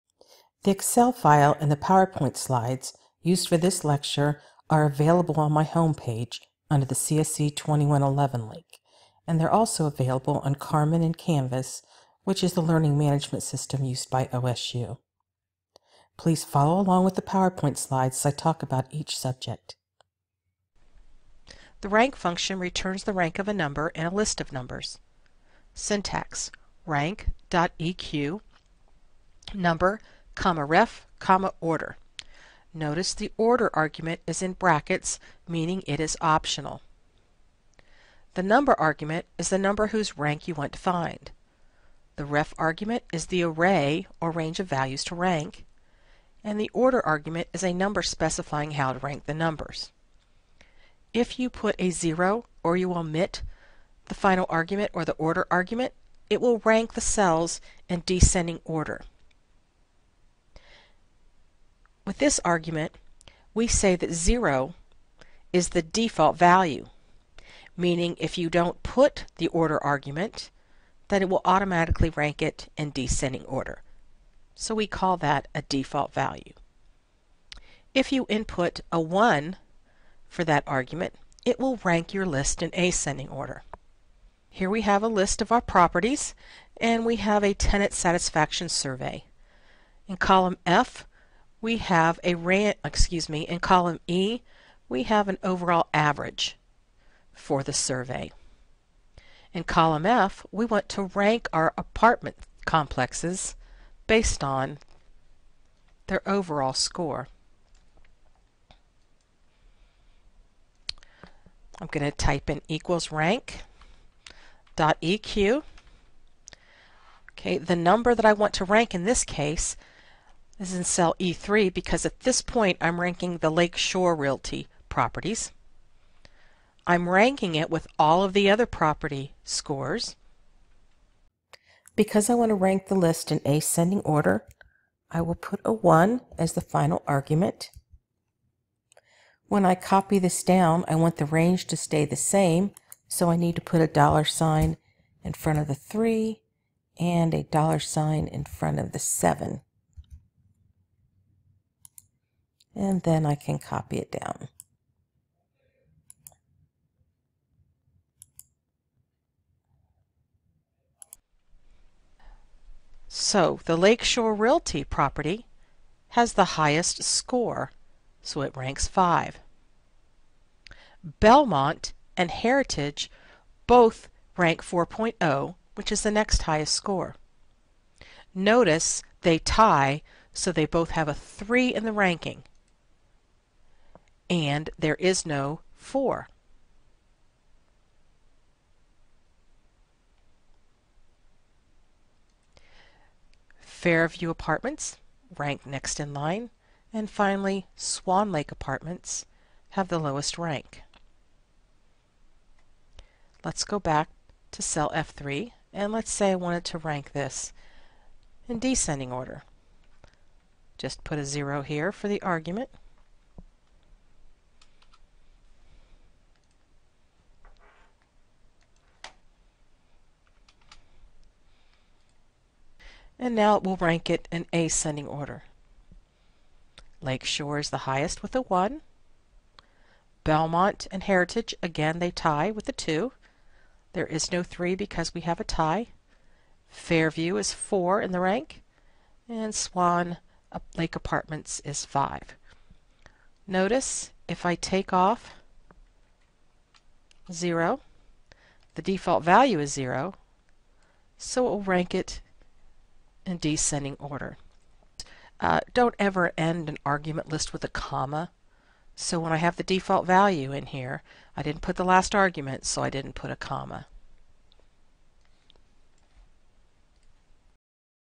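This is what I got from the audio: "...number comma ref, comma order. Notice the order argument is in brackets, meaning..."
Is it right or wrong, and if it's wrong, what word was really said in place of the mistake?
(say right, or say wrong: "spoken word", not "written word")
right.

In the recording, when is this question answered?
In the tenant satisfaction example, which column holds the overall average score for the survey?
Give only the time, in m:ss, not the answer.
1:33.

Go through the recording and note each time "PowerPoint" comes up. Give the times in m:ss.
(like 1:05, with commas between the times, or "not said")
0:01, 0:17.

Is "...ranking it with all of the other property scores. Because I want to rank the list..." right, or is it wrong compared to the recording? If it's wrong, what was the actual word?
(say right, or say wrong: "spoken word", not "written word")
right.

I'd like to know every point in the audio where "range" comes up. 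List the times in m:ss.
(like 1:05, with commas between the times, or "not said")
0:44, 2:21.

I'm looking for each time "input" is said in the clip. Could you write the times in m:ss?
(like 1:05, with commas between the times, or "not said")
1:18.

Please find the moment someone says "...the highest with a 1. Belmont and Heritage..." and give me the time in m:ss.
3:47.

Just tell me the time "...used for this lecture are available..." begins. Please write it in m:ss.
0:03.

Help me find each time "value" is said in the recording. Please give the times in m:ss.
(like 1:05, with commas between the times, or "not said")
0:44, 1:06, 1:16, 4:09, 4:20.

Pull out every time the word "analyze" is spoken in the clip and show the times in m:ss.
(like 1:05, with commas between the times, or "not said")
not said.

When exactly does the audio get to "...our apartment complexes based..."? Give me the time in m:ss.
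1:41.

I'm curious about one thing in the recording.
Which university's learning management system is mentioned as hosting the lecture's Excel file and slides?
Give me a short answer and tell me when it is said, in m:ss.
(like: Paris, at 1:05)
OSU, at 0:14.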